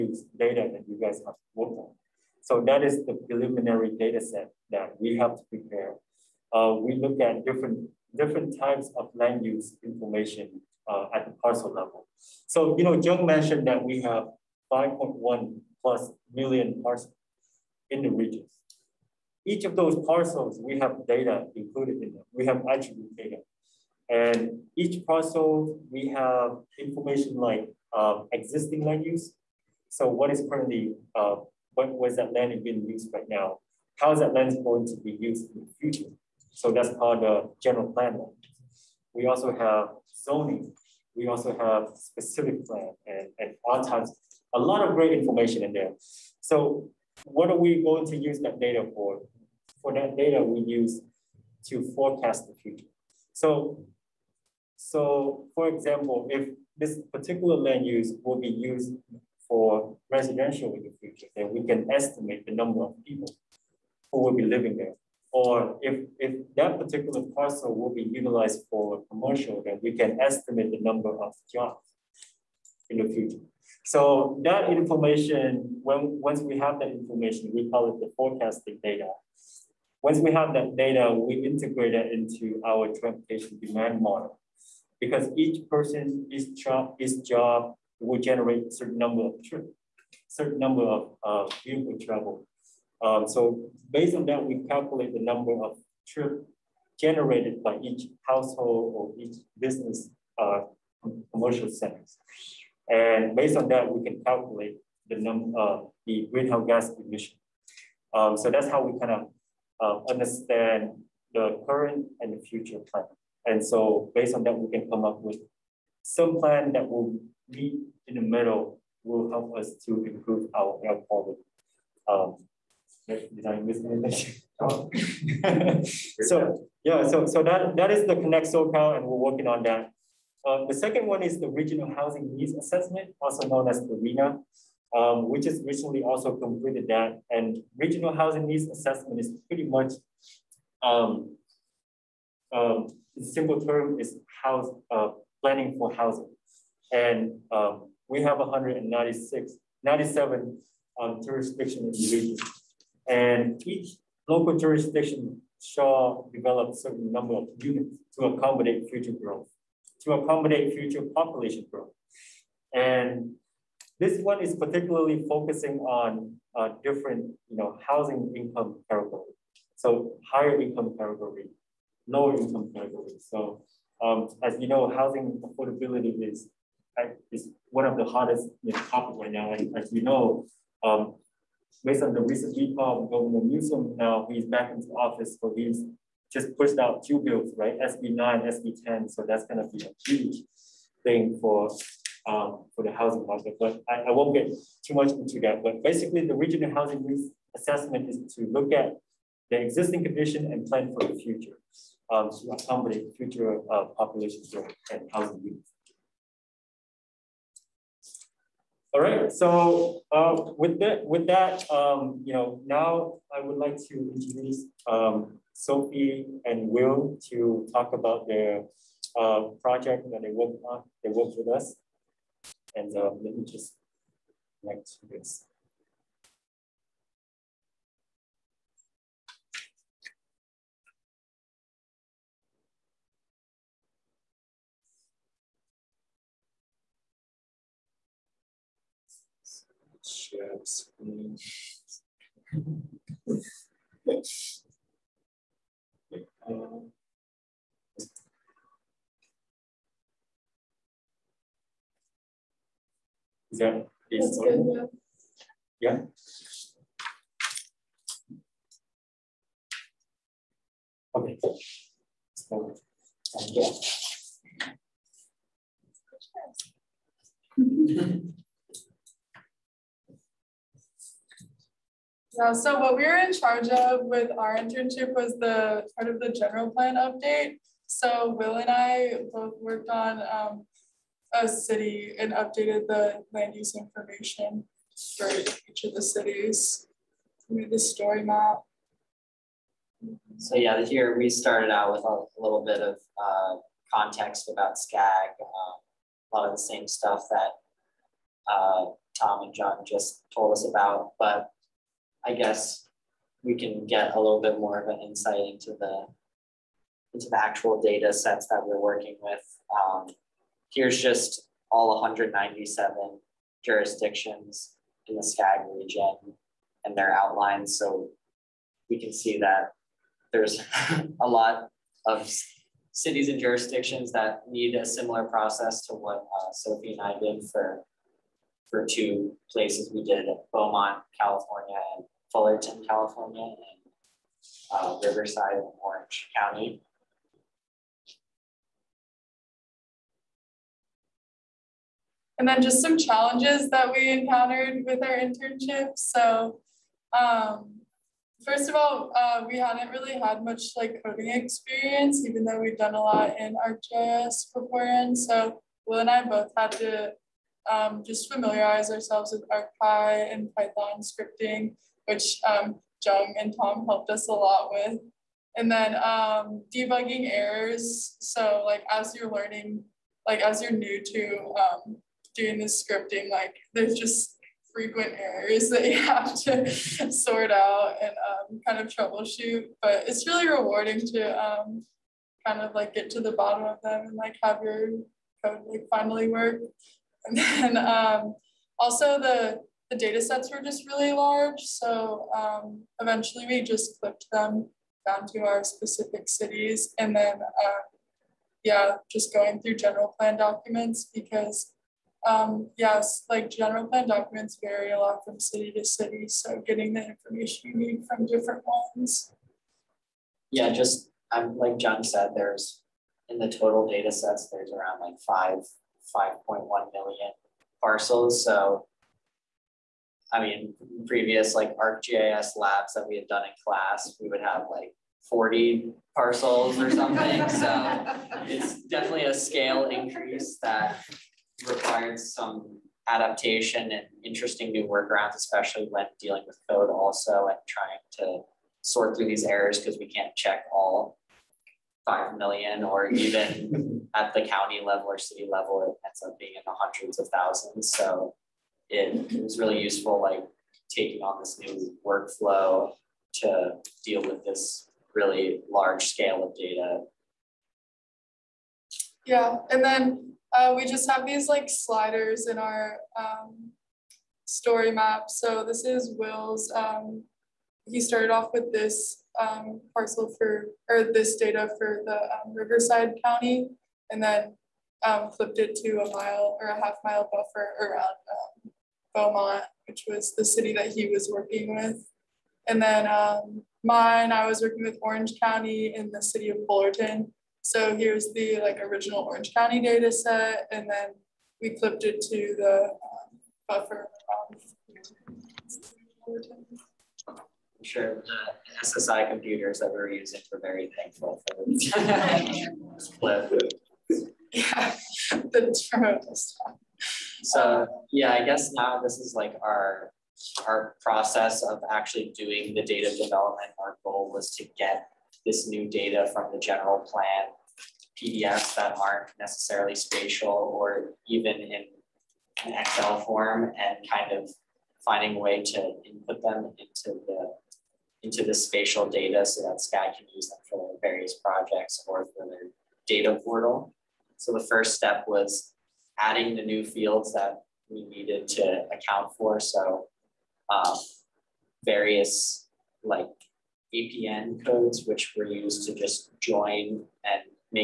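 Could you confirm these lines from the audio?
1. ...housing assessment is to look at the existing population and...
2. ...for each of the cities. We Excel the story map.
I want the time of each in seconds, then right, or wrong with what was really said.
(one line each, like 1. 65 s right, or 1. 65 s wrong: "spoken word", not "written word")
1. 196 s wrong: "condition", not "population"
2. 285 s wrong: "Made", not "Excel".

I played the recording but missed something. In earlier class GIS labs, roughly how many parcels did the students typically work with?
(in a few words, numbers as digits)
40.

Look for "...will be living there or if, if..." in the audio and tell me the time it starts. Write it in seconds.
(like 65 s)
64 s.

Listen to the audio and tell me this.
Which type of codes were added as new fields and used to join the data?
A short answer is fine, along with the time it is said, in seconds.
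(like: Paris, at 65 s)
APN codes, at 543 s.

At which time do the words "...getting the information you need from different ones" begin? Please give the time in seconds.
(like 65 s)
406 s.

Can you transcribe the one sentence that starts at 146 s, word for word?
And um, we have 196, 97 um, jurisdiction in the region.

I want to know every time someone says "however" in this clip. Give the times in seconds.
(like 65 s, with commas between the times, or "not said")
not said.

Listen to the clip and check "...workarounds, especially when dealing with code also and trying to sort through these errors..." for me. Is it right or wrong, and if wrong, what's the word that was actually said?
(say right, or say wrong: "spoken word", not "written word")
right.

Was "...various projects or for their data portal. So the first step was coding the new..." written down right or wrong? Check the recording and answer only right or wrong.
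wrong.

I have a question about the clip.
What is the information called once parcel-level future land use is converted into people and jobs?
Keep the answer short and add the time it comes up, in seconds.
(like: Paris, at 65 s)
forecasting data, at 78 s.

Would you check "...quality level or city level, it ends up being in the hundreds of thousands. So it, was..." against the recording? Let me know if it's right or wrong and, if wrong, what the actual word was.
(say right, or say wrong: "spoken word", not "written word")
wrong: "county", not "quality".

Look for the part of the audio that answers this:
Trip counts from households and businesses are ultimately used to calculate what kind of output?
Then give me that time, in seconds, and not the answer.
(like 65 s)
106 s.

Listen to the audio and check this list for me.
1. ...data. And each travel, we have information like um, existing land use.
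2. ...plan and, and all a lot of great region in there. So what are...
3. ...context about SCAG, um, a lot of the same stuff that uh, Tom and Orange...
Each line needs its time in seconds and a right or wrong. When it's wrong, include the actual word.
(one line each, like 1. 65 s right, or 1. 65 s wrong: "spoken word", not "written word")
1. 23 s wrong: "parcel", not "travel"
2. 42 s wrong: "information", not "region"
3. 293 s wrong: "John", not "Orange".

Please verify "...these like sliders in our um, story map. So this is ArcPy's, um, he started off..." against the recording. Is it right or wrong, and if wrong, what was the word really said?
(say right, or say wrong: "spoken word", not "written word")
wrong: "Will", not "ArcPy".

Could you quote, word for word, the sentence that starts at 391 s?
So um, eventually we just clipped them down to our specific cities.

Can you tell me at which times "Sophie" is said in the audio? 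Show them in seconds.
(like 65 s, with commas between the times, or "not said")
215 s, 326 s.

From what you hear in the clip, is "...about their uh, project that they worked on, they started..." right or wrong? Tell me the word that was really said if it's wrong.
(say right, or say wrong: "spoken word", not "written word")
wrong: "worked", not "started".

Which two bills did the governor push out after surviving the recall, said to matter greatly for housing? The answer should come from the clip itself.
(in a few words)
SB 9, SB 10.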